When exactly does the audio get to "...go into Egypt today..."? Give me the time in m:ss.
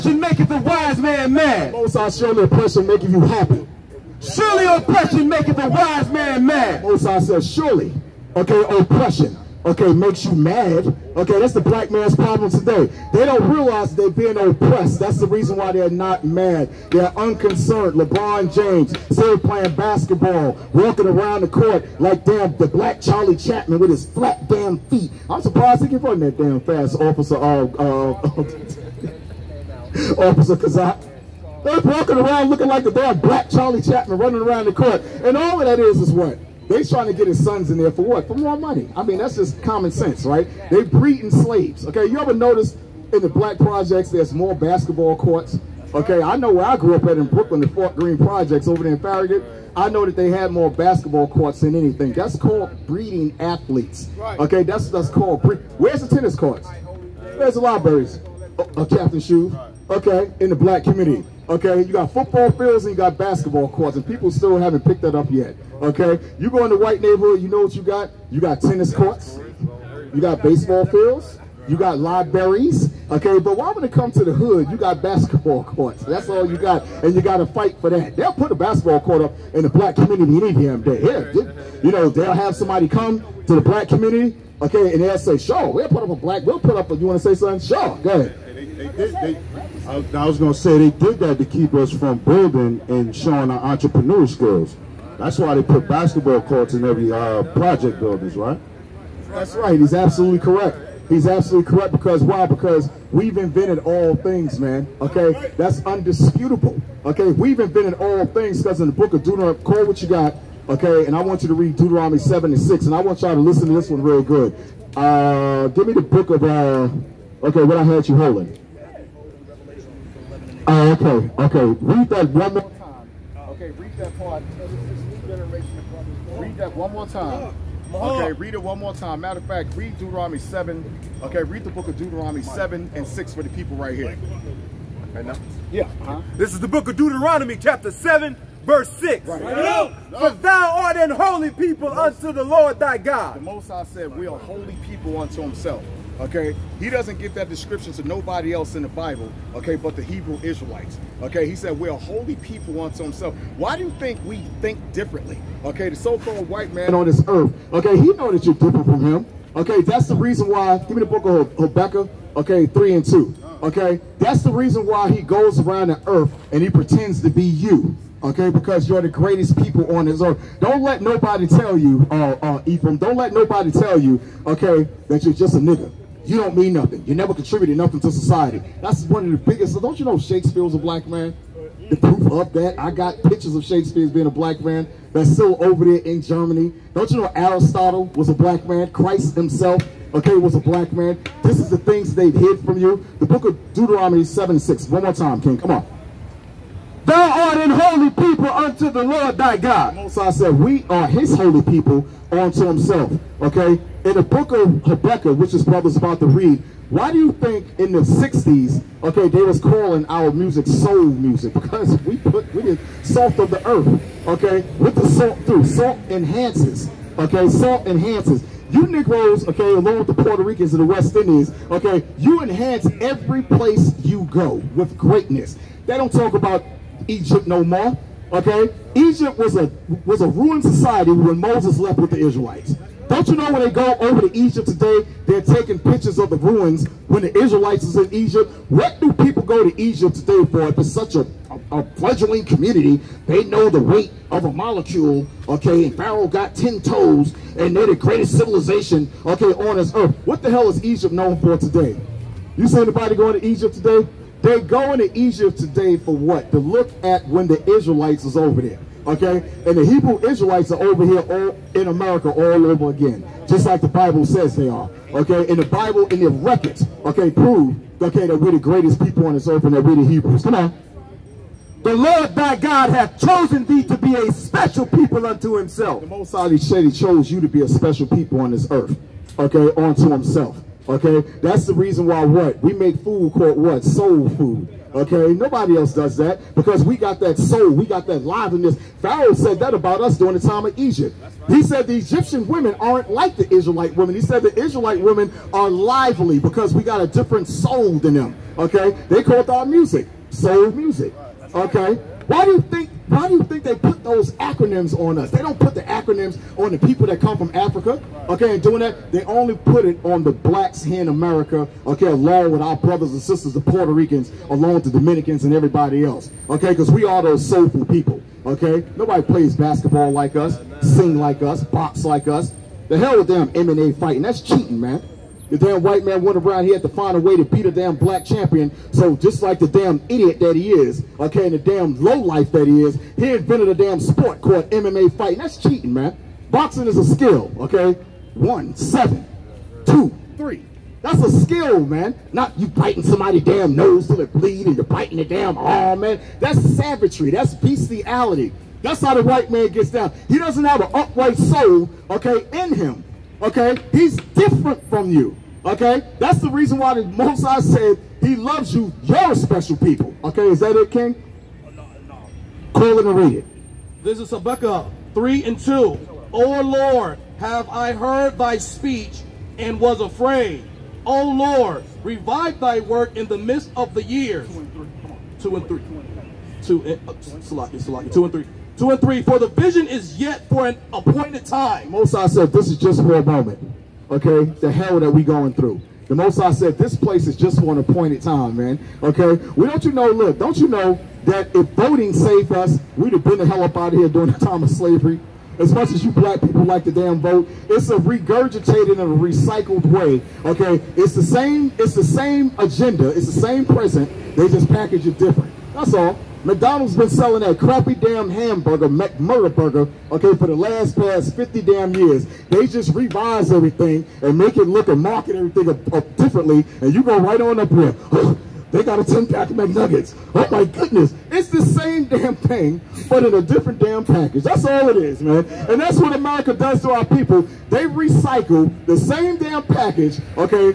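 4:14.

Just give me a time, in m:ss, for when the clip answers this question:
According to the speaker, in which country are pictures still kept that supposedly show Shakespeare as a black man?
3:06.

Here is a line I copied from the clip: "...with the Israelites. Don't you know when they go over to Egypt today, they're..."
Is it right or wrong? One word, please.
right.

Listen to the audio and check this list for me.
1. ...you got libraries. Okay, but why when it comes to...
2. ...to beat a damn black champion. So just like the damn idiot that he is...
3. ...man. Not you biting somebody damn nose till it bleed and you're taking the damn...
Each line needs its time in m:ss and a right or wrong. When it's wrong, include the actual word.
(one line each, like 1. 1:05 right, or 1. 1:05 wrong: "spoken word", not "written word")
1. 1:11 right
2. 5:27 right
3. 5:41 wrong: "biting", not "taking".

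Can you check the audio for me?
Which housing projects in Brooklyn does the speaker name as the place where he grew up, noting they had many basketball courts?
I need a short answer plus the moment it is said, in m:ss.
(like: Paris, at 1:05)
Fort Greene Projects, at 0:47.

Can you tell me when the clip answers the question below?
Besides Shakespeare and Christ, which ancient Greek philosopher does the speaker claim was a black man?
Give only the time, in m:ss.
3:07.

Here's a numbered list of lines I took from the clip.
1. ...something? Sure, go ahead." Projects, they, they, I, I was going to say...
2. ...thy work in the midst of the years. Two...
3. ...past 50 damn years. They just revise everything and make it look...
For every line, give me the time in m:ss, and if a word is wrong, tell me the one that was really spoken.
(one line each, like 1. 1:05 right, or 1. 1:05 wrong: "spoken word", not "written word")
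1. 1:27 wrong: "They", not "Projects"
2. 6:12 right
3. 6:50 right.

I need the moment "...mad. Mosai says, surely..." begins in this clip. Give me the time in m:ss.
0:06.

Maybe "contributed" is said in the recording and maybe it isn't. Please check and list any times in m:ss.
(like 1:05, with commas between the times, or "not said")
2:57.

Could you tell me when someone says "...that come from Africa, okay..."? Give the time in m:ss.
5:07.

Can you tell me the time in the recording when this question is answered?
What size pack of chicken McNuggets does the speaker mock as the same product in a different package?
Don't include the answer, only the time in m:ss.
6:59.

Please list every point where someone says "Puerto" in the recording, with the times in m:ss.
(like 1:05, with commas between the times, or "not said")
3:40, 5:13.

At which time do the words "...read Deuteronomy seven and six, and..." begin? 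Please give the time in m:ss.
1:51.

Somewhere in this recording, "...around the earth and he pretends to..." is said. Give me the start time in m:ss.
2:45.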